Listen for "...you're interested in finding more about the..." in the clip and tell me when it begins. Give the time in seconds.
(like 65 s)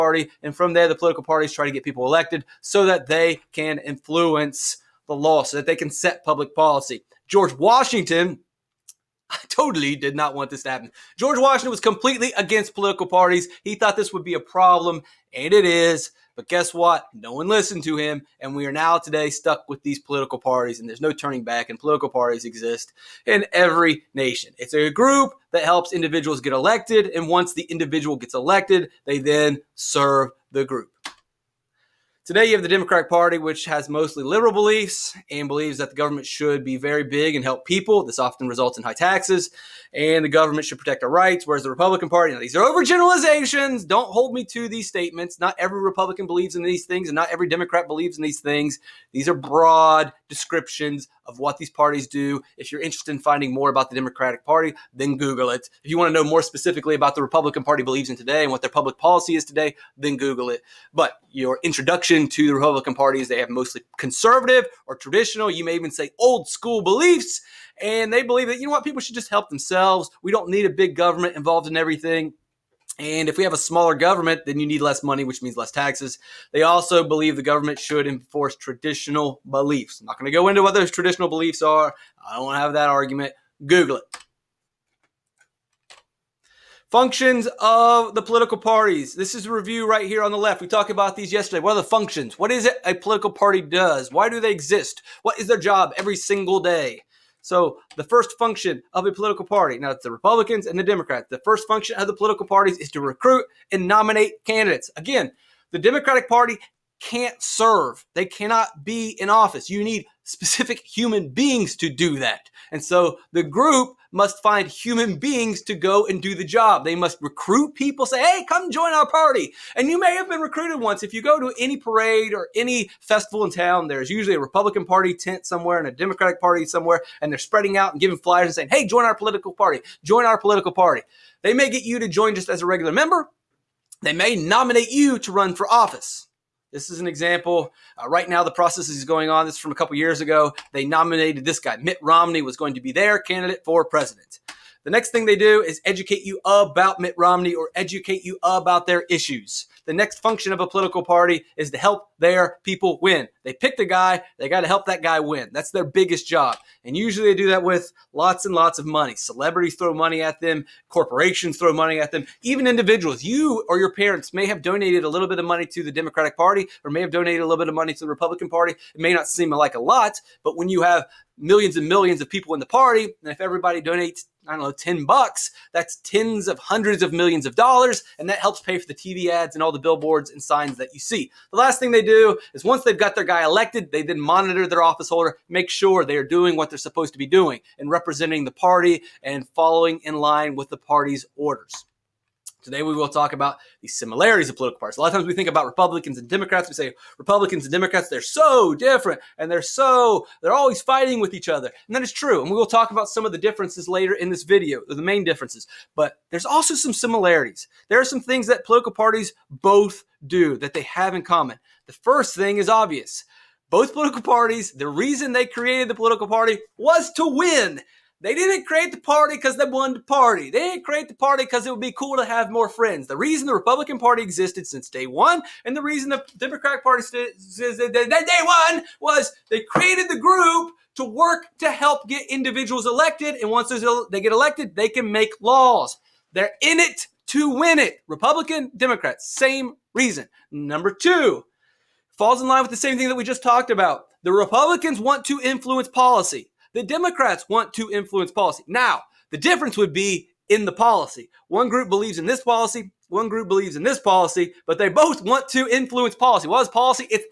52 s.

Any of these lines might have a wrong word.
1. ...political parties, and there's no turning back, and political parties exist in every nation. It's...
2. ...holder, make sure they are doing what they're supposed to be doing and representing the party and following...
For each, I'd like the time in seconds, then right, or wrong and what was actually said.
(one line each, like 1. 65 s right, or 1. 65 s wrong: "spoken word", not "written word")
1. 19 s right
2. 185 s right.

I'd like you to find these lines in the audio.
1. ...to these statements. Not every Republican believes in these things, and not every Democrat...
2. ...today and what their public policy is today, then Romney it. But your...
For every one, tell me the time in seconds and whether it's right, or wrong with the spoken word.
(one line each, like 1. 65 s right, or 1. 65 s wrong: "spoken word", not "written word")
1. 44 s right
2. 58 s wrong: "Google", not "Romney".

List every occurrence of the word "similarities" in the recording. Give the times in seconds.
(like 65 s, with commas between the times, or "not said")
193 s, 206 s.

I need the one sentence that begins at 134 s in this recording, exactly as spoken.
They may nominate you to run for office.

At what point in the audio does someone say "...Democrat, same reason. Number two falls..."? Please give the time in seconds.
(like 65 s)
238 s.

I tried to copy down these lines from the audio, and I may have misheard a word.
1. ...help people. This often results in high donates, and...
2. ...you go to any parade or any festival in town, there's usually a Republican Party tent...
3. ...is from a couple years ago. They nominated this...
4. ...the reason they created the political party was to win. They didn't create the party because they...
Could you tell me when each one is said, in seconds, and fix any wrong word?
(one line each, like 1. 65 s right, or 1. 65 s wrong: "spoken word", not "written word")
1. 37 s wrong: "taxes", not "donates"
2. 121 s right
3. 139 s right
4. 214 s right.